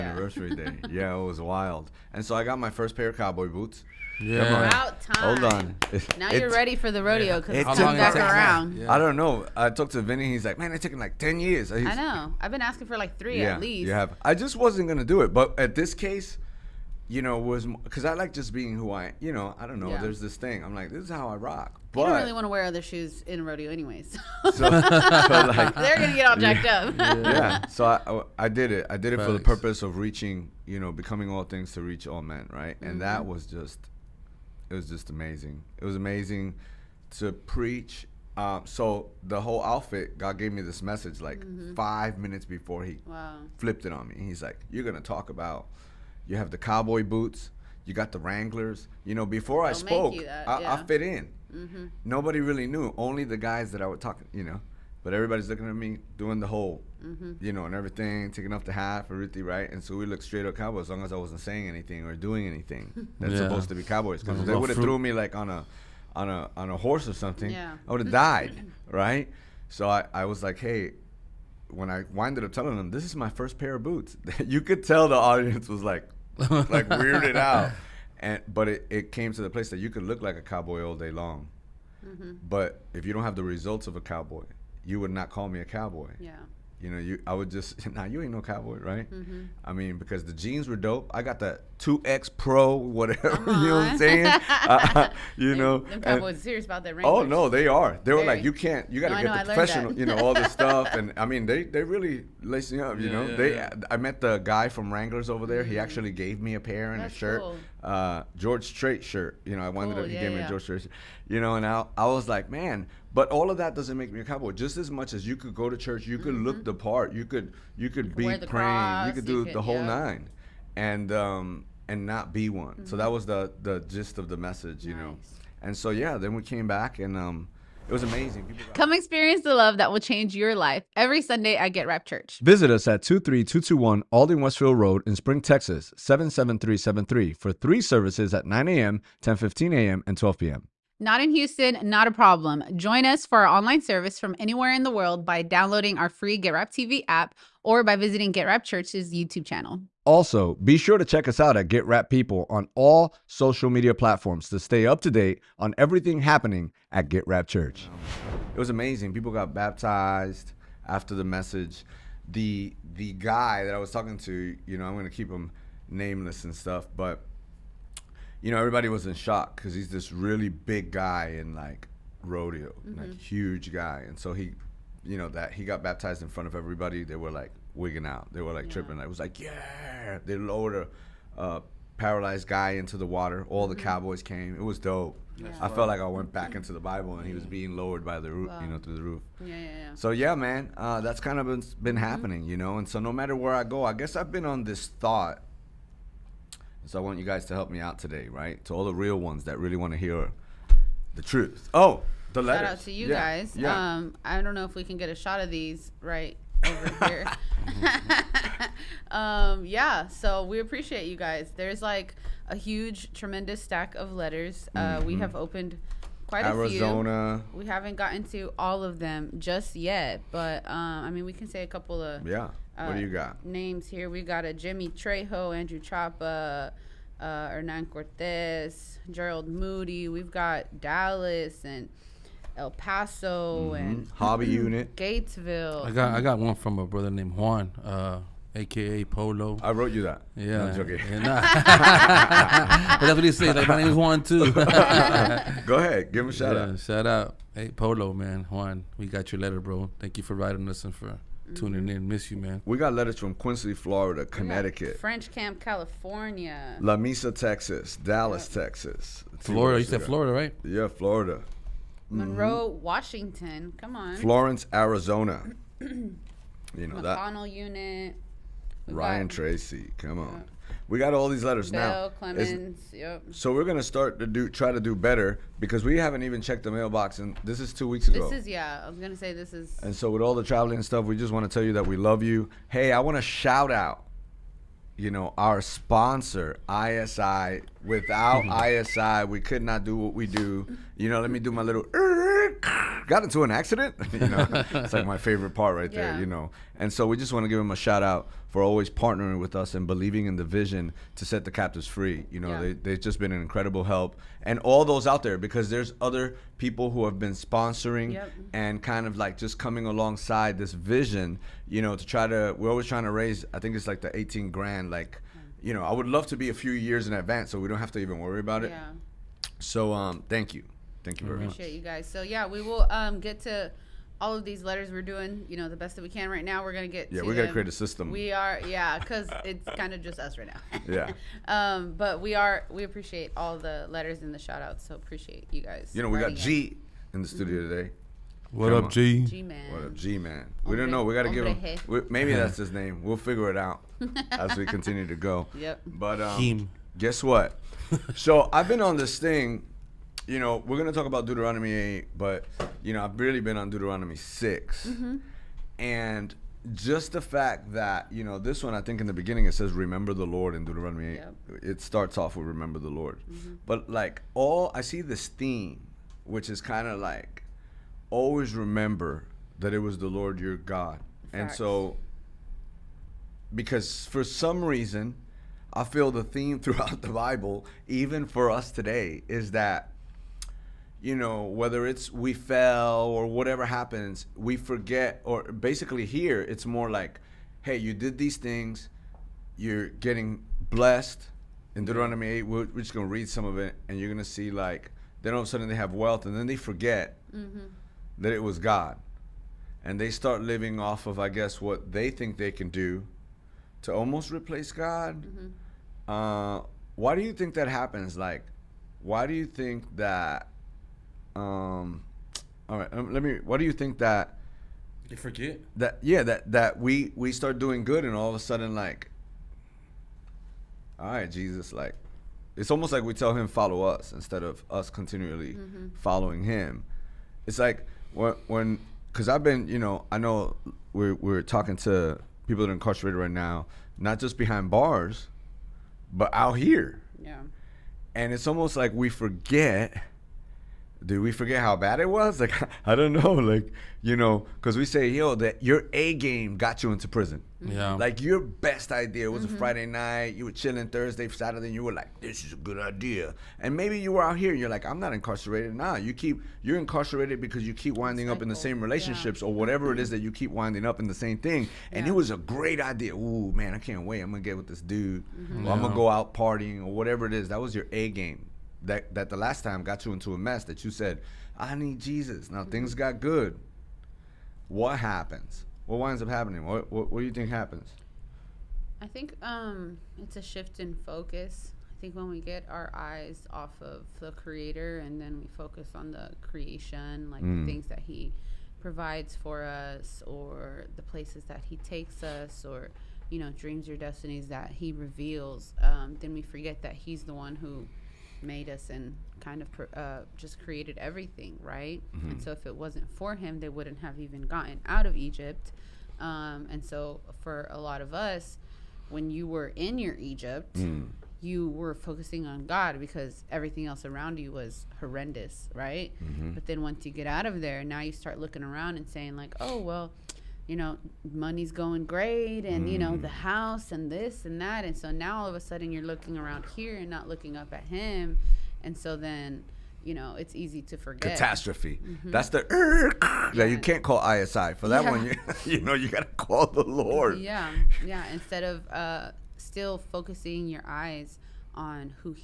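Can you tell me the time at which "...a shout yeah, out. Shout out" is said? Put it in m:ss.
4:06.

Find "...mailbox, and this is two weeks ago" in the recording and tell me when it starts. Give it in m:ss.
4:36.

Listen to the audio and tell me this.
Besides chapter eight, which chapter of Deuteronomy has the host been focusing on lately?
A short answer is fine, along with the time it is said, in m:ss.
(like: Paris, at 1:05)
Deuteronomy 6, at 5:53.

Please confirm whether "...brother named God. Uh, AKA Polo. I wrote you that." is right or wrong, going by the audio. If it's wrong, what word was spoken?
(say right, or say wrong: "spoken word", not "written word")
wrong: "Juan", not "God".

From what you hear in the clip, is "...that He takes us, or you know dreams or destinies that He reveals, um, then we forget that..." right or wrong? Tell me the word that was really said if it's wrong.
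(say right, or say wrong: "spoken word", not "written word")
right.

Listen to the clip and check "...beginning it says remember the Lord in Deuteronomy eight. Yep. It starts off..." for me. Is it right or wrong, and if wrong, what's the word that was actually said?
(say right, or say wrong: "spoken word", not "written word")
right.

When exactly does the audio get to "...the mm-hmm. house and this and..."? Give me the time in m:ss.
8:43.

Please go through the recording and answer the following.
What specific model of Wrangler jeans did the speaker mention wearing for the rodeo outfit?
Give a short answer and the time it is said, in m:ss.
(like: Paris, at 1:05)
2X Pro, at 1:31.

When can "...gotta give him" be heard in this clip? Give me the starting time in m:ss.
5:41.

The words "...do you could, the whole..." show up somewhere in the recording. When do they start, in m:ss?
1:59.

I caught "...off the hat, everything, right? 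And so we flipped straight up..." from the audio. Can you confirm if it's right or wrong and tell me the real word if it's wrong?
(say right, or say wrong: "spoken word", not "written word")
wrong: "looked", not "flipped".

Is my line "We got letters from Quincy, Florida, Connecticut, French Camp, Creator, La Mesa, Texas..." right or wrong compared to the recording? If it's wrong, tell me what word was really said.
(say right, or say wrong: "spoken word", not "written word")
wrong: "California", not "Creator".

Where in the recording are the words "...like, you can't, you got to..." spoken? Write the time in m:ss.
1:38.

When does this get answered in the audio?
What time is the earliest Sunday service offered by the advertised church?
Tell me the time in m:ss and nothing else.
2:18.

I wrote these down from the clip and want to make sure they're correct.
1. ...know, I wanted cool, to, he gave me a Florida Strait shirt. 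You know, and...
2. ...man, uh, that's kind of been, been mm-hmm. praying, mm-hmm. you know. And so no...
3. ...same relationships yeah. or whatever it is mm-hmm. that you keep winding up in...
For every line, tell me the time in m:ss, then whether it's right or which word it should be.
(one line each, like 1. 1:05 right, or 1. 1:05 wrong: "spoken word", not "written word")
1. 1:49 wrong: "George", not "Florida"
2. 3:10 wrong: "happening", not "praying"
3. 7:38 right.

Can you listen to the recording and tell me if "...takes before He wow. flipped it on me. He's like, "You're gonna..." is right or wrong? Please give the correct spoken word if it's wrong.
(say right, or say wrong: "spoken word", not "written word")
wrong: "minutes", not "takes".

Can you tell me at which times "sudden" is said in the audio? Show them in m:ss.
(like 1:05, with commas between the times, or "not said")
6:35, 6:58, 8:45.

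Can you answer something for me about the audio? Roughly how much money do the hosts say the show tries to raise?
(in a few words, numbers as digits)
18 grand.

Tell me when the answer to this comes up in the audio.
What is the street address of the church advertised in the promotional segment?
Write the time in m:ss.
2:13.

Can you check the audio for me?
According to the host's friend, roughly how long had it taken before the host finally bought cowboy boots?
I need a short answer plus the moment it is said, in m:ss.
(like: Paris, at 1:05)
10 years, at 0:11.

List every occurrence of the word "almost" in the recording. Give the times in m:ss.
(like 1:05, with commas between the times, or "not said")
6:43, 7:02, 7:18.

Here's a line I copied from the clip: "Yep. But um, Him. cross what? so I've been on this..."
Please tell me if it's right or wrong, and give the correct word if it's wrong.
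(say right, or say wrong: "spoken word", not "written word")
wrong: "guess", not "cross".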